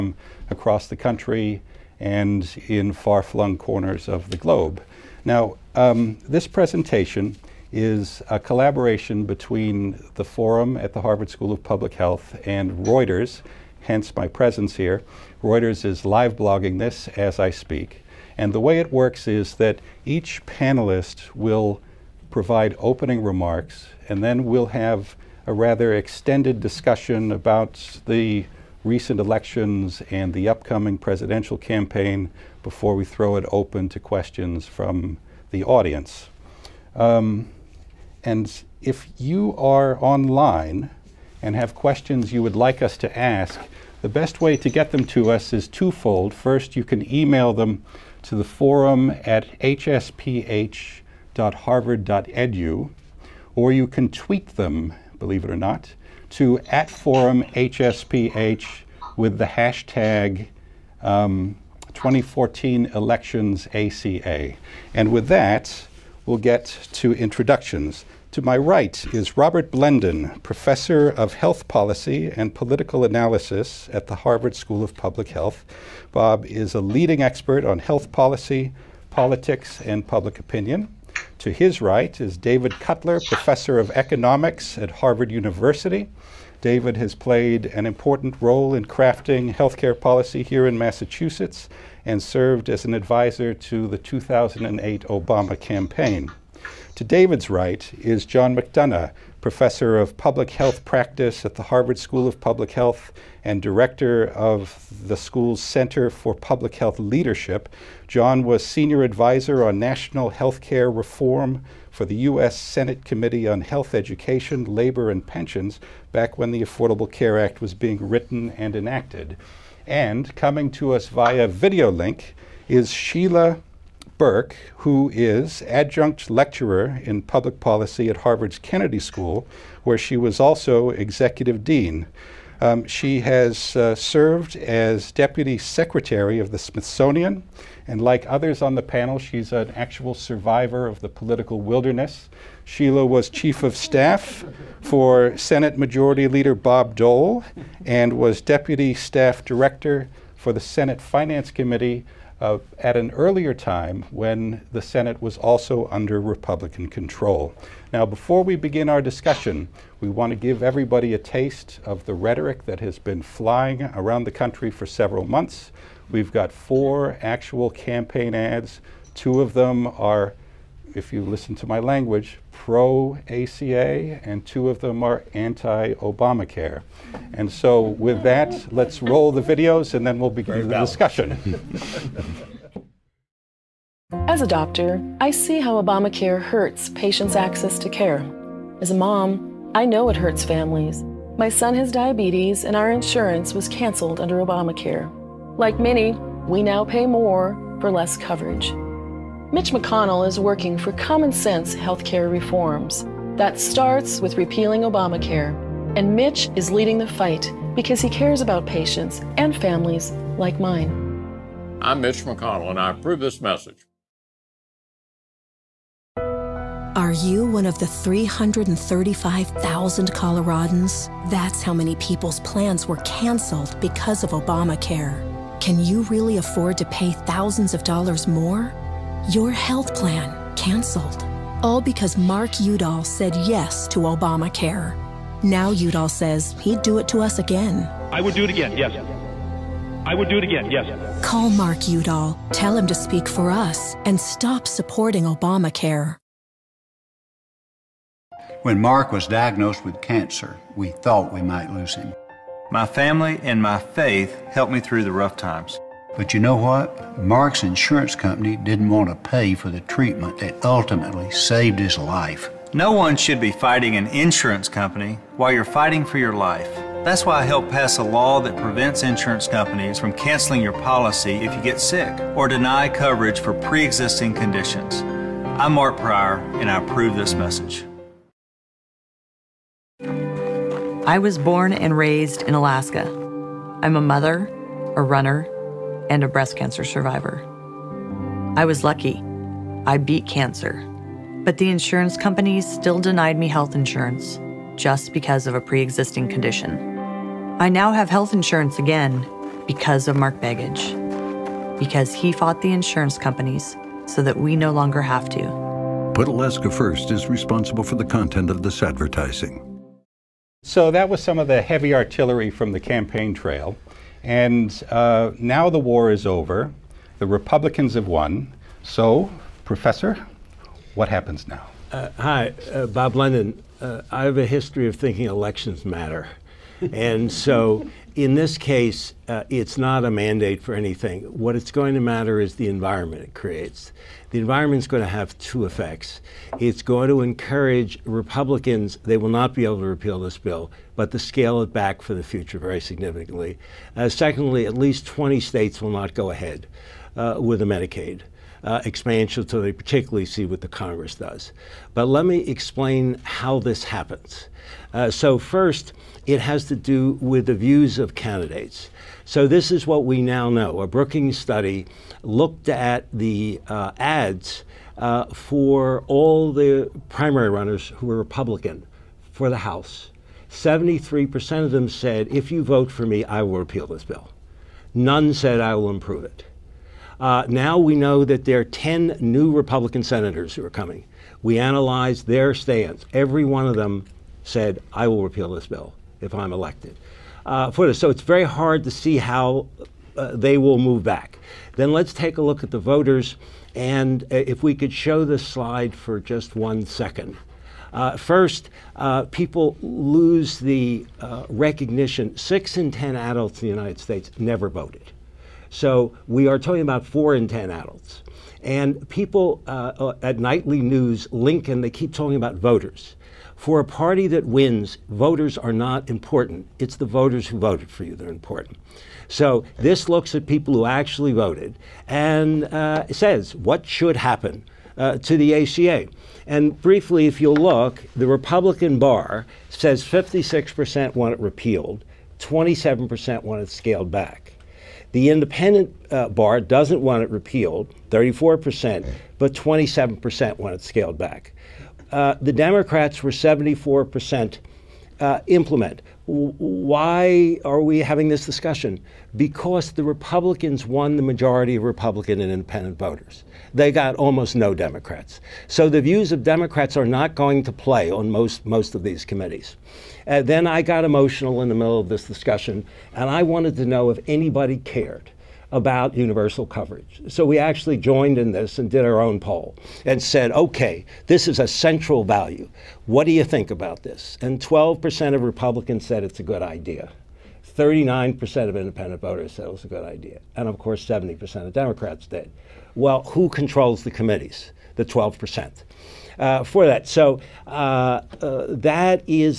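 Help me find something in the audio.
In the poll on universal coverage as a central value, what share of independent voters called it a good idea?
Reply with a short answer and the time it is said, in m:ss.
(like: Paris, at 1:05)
39%, at 7:57.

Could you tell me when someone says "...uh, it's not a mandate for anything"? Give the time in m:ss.
5:29.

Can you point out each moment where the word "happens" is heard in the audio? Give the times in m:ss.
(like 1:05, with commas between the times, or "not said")
5:21, 5:53, 7:04.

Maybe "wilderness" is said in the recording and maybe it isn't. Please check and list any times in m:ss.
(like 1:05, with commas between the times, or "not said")
2:21.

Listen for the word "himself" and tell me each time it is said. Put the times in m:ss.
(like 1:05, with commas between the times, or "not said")
not said.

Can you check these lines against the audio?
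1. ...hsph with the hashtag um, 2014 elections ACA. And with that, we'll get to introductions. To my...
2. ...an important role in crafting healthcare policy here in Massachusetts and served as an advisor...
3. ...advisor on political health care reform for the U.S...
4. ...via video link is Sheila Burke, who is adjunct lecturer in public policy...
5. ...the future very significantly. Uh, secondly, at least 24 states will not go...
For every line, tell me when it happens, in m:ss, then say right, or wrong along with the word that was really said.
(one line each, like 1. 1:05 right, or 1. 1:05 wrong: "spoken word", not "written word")
1. 0:57 right
2. 1:27 right
3. 1:49 wrong: "national", not "political"
4. 2:01 right
5. 5:42 wrong: "20", not "24".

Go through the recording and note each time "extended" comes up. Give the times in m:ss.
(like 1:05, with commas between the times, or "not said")
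0:25.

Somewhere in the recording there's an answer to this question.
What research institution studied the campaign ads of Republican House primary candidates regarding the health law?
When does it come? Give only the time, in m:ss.
6:00.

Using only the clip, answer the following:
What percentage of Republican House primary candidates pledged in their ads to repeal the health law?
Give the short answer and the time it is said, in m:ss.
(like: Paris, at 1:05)
73%, at 6:10.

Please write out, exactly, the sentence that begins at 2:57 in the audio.
And so, with that, let's roll the videos and then we'll begin the discussion.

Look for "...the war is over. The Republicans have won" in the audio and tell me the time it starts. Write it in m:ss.
5:15.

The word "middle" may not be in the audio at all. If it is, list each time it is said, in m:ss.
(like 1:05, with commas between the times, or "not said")
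7:41.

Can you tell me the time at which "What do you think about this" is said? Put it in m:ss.
7:53.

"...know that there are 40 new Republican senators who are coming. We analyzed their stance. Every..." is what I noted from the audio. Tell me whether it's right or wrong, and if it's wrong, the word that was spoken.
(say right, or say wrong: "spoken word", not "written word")
wrong: "10", not "40".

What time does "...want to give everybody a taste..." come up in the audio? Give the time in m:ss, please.
2:40.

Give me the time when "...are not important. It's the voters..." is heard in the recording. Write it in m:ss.
6:55.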